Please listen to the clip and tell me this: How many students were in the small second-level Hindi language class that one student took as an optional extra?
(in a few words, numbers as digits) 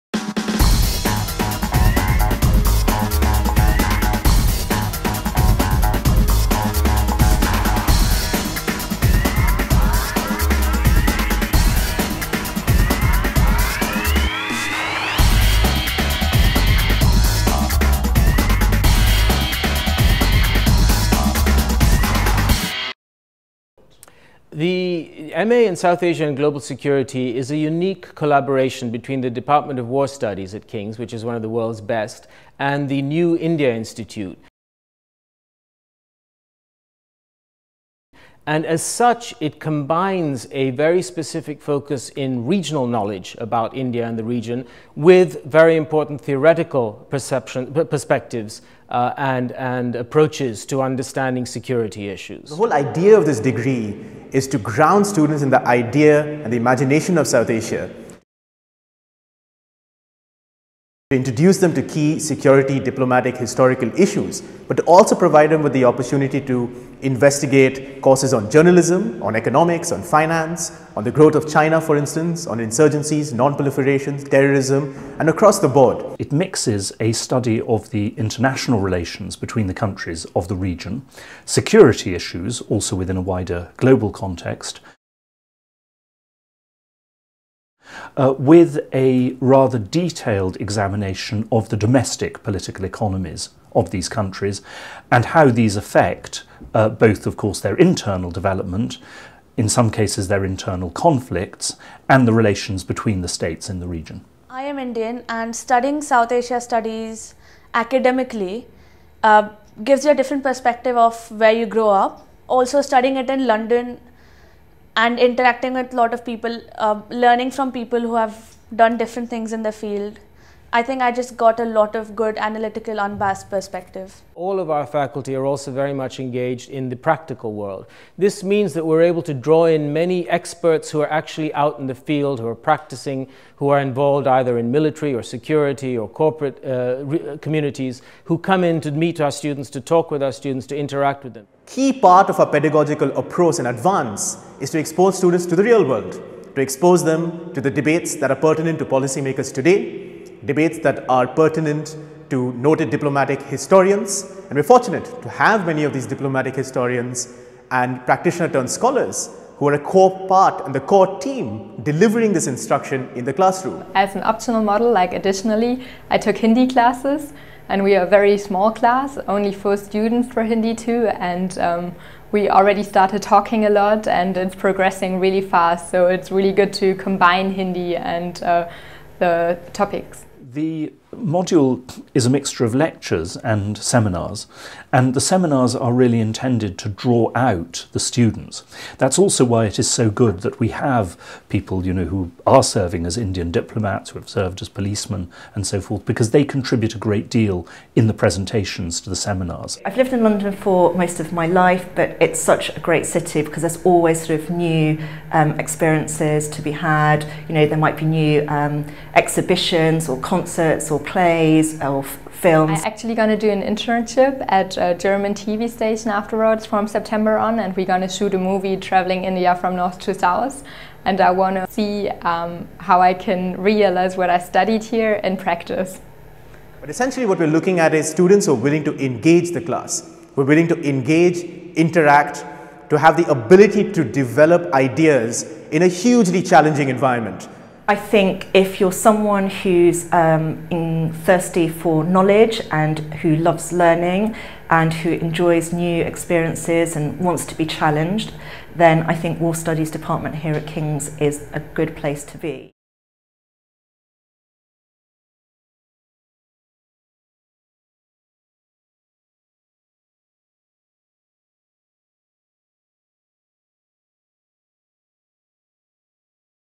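4.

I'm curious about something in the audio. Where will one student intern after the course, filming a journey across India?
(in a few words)
German TV station.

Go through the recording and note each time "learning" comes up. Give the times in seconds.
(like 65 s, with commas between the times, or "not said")
117 s, 243 s.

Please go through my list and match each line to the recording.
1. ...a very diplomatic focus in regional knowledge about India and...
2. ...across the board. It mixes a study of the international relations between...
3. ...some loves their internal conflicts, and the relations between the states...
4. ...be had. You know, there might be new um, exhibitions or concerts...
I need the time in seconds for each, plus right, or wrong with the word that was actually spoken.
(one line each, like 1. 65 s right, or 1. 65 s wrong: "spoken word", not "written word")
1. 40 s wrong: "specific", not "diplomatic"
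2. 75 s right
3. 99 s wrong: "cases", not "loves"
4. 206 s right.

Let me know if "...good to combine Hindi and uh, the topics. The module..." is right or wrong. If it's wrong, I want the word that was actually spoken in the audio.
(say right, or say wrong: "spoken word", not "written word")
right.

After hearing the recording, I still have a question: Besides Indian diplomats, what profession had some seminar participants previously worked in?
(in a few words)
policemen.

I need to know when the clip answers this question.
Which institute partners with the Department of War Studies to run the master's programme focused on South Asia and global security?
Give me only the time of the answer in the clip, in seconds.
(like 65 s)
33 s.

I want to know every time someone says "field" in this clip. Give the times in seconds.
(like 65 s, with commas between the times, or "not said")
119 s, 131 s.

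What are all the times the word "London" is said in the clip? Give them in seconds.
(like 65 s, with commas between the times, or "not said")
113 s, 200 s.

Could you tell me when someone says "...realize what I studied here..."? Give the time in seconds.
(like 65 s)
223 s.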